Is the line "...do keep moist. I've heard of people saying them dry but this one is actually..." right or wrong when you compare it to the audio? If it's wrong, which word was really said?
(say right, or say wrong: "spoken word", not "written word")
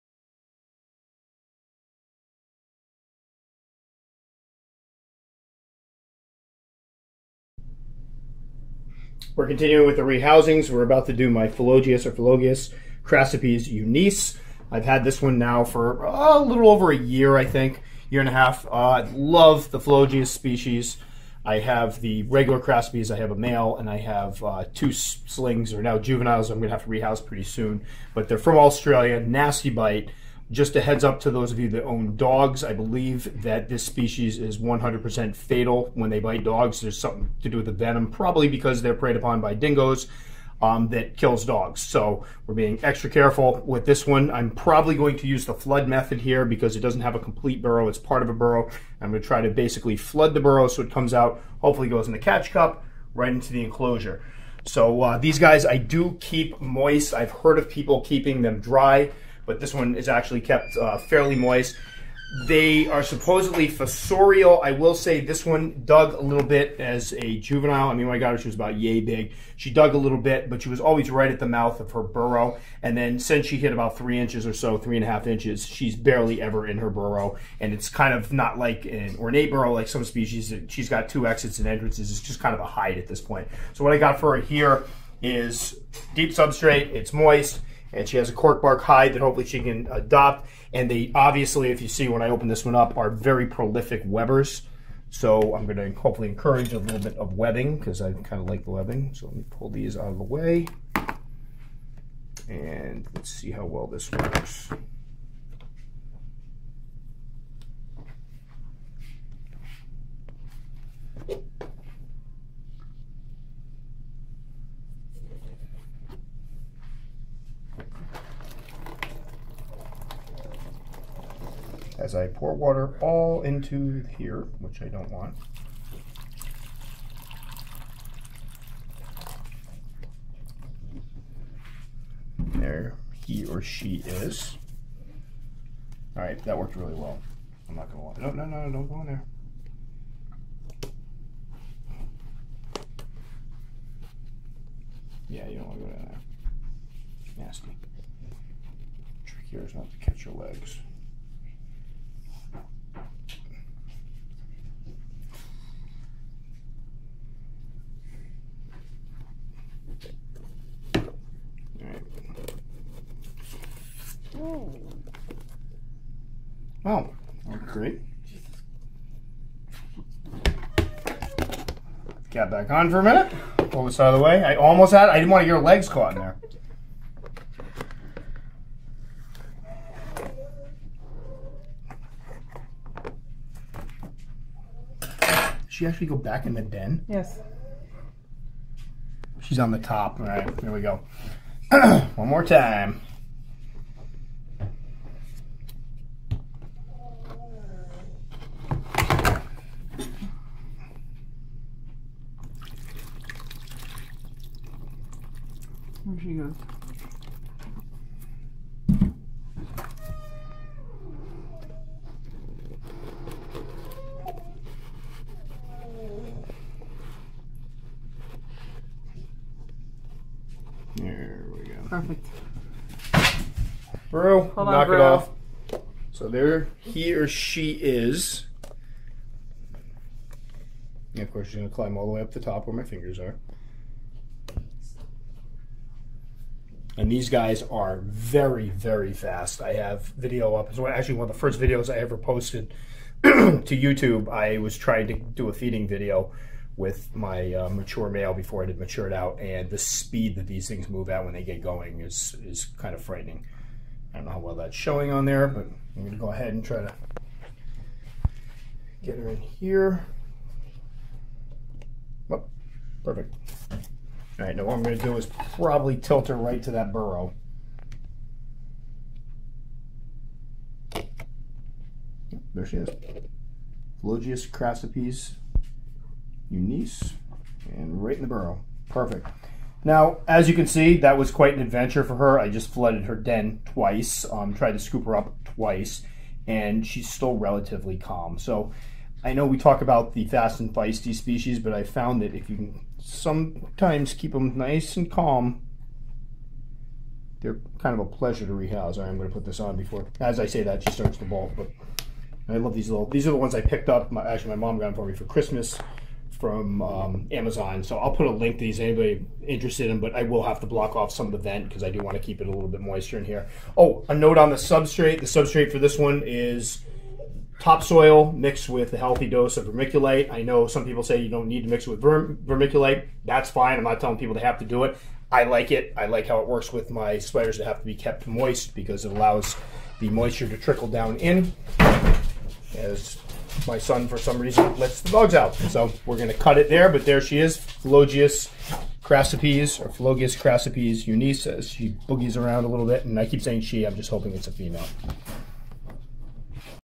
wrong: "keeping", not "saying".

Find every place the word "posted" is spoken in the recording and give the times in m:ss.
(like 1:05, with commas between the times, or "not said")
4:02.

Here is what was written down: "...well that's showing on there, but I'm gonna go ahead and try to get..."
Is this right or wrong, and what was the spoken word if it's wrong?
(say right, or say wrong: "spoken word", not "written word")
right.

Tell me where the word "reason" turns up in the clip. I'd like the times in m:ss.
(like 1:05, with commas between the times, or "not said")
5:34.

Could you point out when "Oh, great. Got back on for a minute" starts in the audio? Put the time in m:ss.
2:46.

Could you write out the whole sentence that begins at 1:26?
It's moist and she has a cork bark hide that hopefully she can adopt.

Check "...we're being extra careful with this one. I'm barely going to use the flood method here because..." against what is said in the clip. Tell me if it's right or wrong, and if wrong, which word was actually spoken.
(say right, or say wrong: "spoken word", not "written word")
wrong: "probably", not "barely".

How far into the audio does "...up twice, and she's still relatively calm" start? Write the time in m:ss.
4:45.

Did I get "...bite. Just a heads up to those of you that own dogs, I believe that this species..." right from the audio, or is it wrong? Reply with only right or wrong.
right.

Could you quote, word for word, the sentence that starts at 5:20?
I know some people say you don't need to mix it with verm- vermiculite.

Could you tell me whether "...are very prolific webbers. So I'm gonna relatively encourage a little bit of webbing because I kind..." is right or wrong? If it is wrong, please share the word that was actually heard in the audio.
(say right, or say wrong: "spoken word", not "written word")
wrong: "hopefully", not "relatively".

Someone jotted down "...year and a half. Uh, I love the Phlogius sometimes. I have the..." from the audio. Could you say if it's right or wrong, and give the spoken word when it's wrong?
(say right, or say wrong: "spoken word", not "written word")
wrong: "species", not "sometimes".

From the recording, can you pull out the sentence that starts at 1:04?
I will say this one dug a little bit as a juvenile.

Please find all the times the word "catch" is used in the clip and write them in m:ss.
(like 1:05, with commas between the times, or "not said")
0:52, 2:29.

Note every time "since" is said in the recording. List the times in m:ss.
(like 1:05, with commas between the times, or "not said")
1:13.